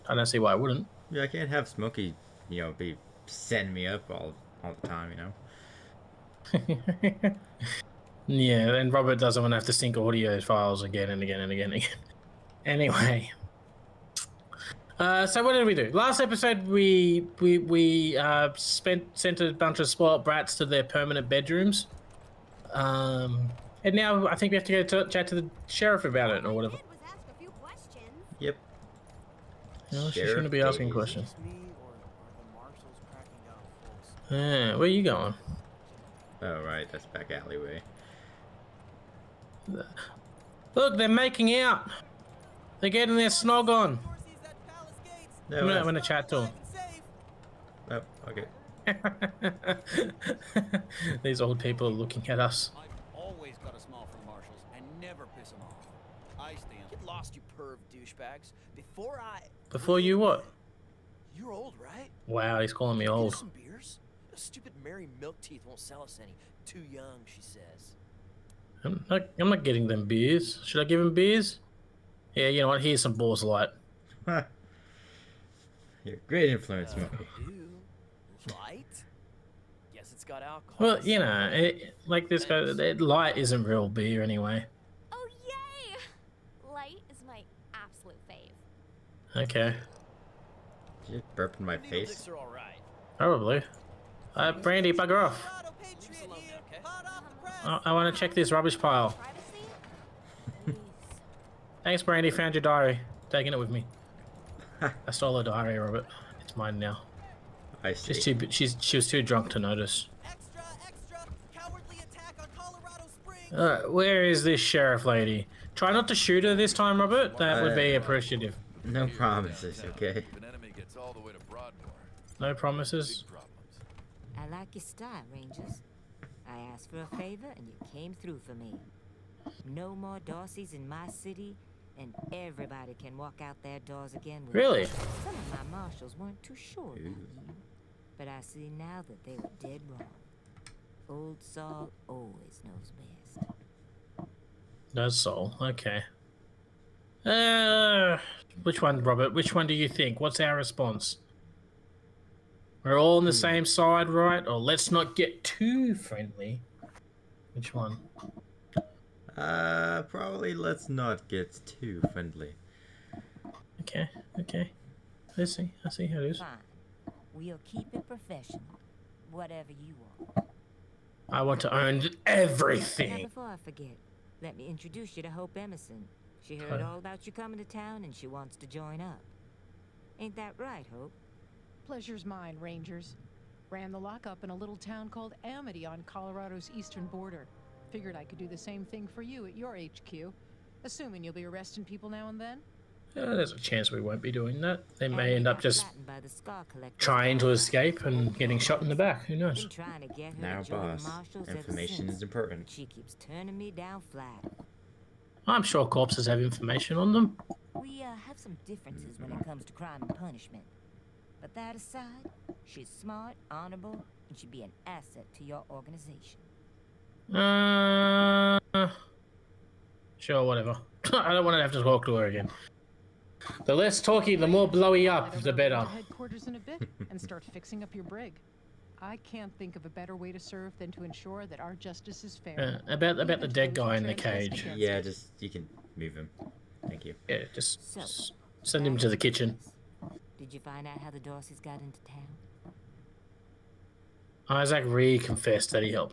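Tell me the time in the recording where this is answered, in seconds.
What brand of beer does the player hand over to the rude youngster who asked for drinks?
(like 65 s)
73 s.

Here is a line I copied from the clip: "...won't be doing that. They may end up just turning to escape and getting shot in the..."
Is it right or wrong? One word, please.
wrong.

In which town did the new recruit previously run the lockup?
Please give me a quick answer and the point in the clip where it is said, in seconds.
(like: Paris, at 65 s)
Amity, at 185 s.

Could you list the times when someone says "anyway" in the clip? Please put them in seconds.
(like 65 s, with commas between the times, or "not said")
12 s, 84 s.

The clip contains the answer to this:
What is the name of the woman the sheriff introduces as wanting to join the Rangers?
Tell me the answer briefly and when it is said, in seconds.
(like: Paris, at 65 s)
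Hope Emerson, at 175 s.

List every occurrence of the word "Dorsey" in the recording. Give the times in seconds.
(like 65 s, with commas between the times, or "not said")
130 s, 241 s.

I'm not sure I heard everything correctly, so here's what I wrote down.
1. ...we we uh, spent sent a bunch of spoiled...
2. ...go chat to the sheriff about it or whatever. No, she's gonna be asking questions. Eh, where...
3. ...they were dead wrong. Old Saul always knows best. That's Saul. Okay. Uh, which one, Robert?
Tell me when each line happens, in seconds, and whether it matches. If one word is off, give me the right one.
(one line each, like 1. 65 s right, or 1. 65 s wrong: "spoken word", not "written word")
1. 17 s right
2. 24 s right
3. 139 s right.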